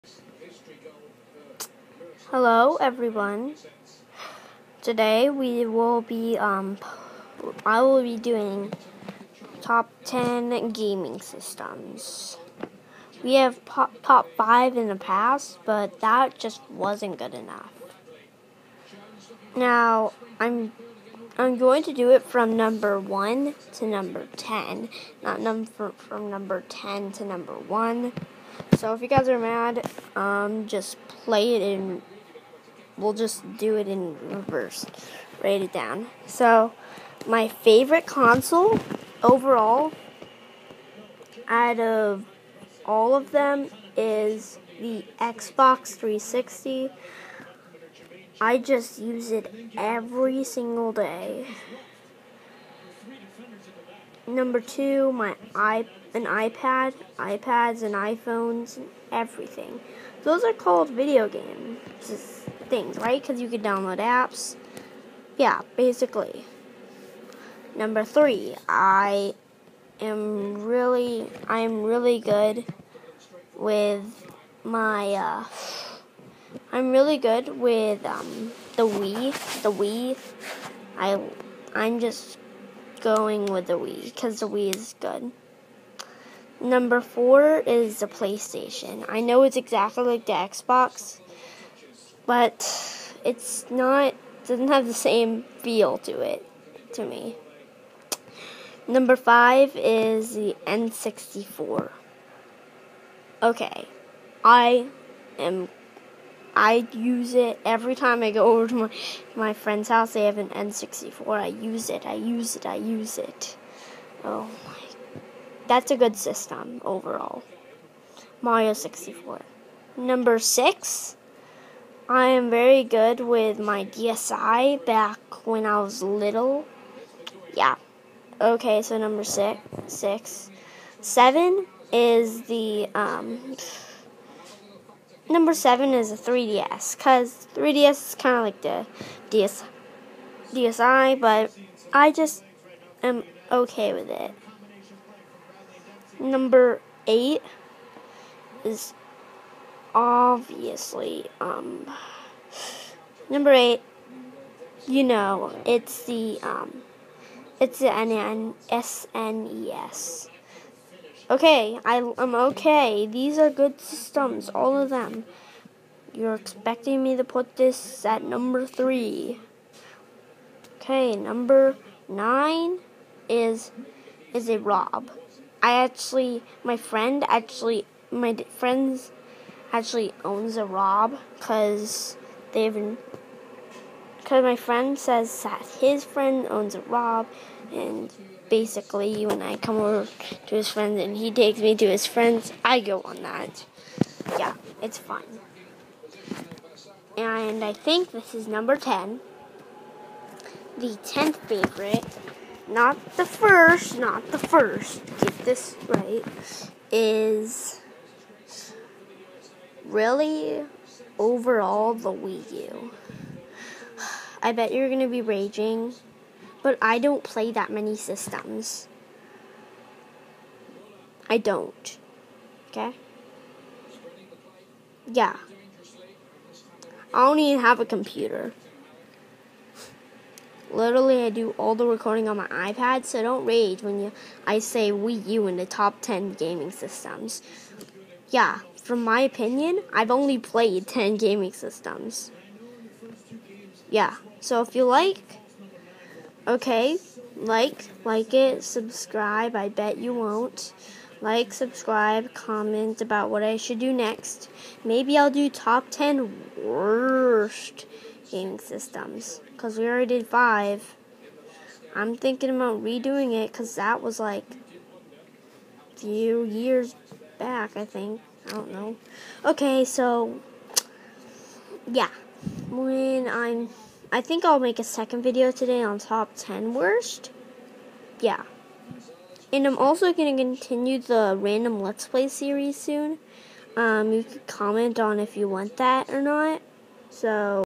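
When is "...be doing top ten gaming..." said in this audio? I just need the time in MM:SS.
00:08.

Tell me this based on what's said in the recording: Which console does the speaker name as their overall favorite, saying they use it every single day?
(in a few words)
Xbox 360.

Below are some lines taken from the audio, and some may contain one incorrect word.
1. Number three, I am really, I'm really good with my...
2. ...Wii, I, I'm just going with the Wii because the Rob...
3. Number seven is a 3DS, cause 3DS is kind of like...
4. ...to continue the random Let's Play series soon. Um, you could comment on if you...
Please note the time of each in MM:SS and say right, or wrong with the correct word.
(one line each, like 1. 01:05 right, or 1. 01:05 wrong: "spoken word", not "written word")
1. 01:07 right
2. 01:19 wrong: "Wii", not "Rob"
3. 02:15 right
4. 04:40 right.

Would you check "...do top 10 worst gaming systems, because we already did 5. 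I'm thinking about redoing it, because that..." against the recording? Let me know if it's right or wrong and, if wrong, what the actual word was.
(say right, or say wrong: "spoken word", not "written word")
right.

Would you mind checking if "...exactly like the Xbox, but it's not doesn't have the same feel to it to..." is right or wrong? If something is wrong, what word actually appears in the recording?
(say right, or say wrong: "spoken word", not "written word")
right.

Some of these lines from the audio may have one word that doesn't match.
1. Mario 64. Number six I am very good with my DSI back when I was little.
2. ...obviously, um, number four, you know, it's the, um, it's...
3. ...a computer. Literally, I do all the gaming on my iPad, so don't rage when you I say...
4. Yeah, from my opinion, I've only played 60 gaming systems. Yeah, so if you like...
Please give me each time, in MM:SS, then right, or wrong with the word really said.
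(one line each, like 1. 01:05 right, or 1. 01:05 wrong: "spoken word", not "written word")
1. 01:58 right
2. 02:29 wrong: "eight", not "four"
3. 03:47 wrong: "recording", not "gaming"
4. 03:58 wrong: "10", not "60".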